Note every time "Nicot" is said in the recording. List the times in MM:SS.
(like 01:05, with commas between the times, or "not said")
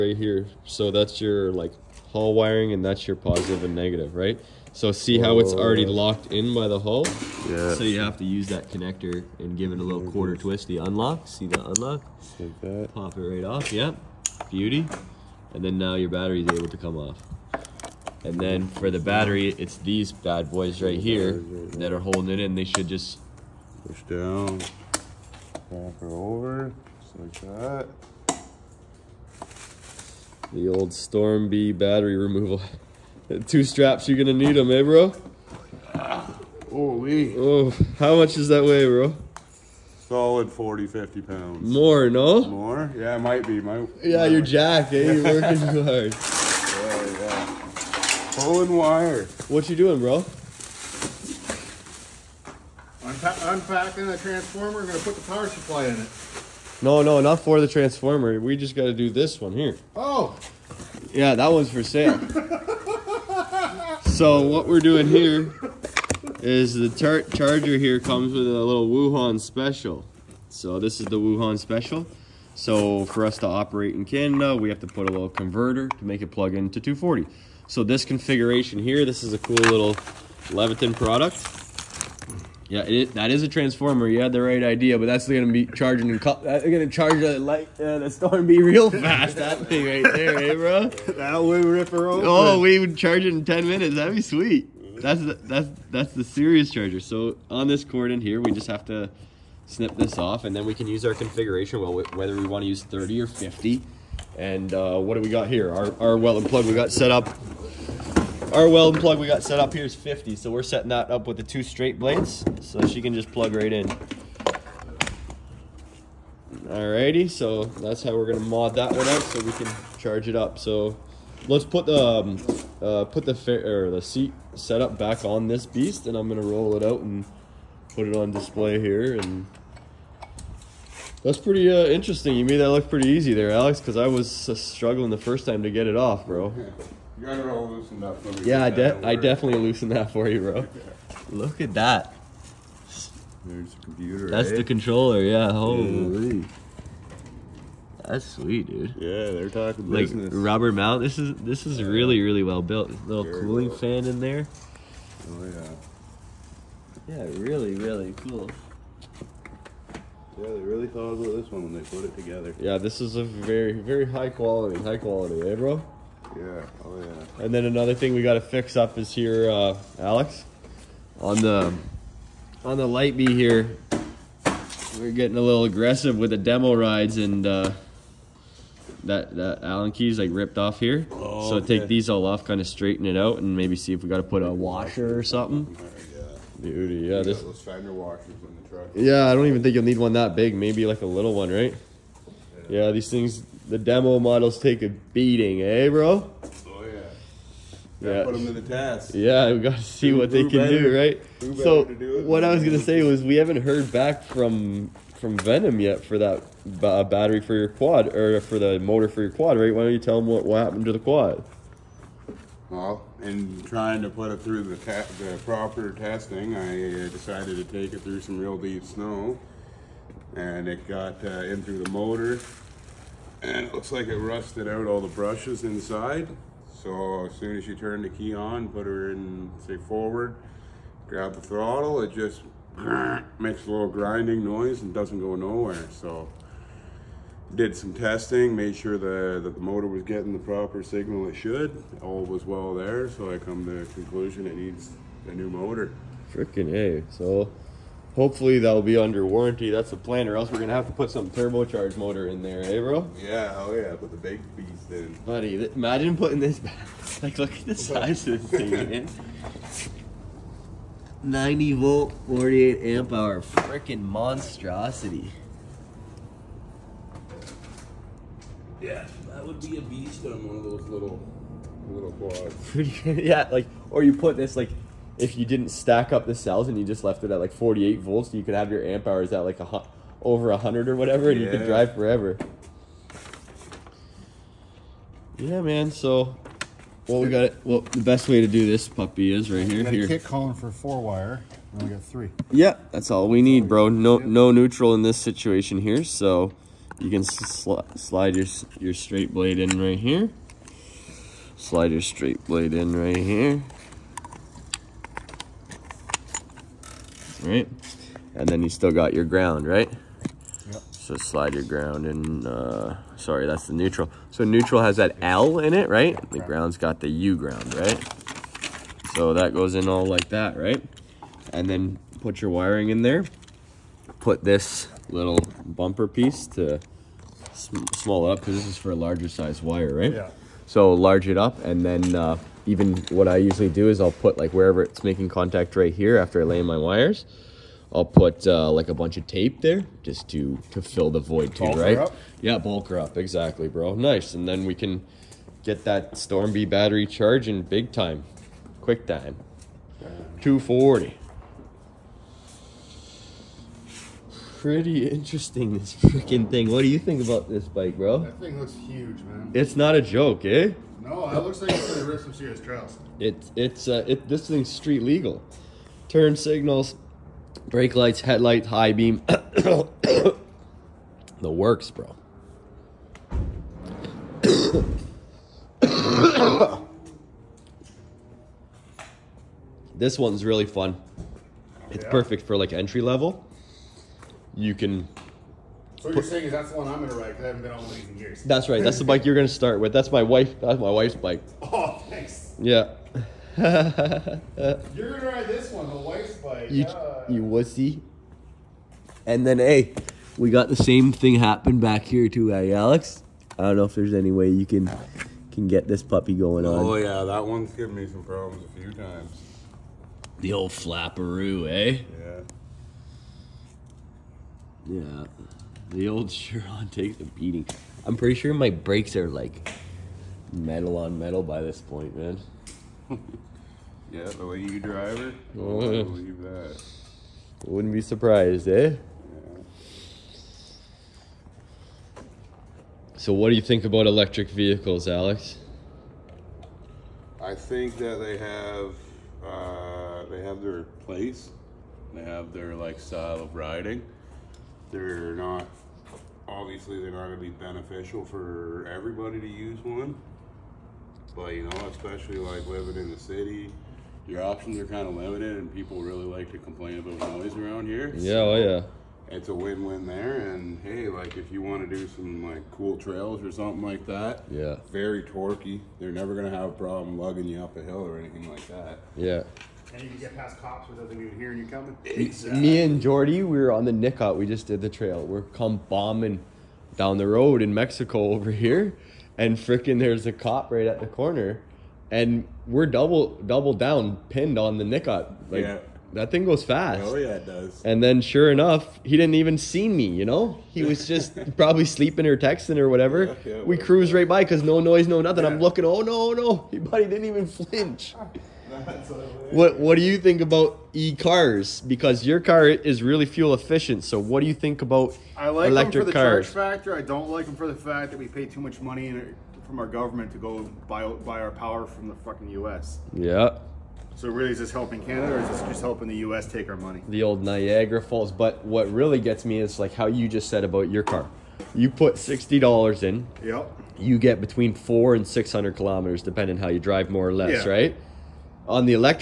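07:53, 08:04.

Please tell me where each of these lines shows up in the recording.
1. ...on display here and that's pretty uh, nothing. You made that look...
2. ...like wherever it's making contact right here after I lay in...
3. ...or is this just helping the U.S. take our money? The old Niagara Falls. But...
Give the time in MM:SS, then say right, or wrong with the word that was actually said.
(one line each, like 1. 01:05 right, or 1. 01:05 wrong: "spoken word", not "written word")
1. 02:08 wrong: "interesting", not "nothing"
2. 05:34 right
3. 08:35 right.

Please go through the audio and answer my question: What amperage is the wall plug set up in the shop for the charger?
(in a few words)
50.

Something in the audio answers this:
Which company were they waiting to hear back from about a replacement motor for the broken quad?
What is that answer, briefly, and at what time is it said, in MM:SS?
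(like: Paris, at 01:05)
Venom, at 03:25.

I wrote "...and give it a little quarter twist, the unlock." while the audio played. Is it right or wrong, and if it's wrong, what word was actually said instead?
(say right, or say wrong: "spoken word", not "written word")
right.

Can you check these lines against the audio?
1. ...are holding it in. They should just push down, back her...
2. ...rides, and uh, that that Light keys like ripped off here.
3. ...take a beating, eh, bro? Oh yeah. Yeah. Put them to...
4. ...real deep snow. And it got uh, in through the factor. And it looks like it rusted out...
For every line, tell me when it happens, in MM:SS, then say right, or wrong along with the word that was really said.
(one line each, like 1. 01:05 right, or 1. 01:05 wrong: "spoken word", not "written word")
1. 00:21 right
2. 02:56 wrong: "Allen", not "Light"
3. 03:14 right
4. 03:38 wrong: "motor", not "factor".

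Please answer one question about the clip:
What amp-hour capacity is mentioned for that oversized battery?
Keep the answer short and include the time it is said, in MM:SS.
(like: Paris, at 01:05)
48 amp hour, at 04:22.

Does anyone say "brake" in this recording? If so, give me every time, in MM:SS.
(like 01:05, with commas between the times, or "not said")
06:07, 06:58.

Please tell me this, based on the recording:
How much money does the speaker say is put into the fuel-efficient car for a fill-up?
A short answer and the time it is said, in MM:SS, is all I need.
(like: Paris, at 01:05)
$60, at 08:42.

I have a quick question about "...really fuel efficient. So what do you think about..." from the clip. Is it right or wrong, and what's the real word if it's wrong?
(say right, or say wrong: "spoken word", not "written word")
right.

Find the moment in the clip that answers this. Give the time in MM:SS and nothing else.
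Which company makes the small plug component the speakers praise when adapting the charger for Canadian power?
01:20.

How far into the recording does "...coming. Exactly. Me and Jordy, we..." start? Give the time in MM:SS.
07:51.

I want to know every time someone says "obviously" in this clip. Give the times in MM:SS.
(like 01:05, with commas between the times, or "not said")
07:26.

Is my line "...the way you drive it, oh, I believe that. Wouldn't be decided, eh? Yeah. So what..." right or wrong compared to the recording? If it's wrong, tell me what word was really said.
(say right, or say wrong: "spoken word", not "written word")
wrong: "surprised", not "decided".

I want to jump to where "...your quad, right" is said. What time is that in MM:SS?
03:29.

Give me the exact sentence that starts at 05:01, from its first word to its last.
Slide your straight blade in right here.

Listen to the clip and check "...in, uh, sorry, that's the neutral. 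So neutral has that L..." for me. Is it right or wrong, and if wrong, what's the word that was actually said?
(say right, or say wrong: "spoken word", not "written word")
right.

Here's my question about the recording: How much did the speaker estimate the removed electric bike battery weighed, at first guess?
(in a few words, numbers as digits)
40, 50 pounds.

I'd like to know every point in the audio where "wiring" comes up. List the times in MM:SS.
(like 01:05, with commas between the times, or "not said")
00:02, 05:22.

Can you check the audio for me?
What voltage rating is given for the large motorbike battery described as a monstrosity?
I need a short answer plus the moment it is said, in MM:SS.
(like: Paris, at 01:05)
90 volt, at 04:21.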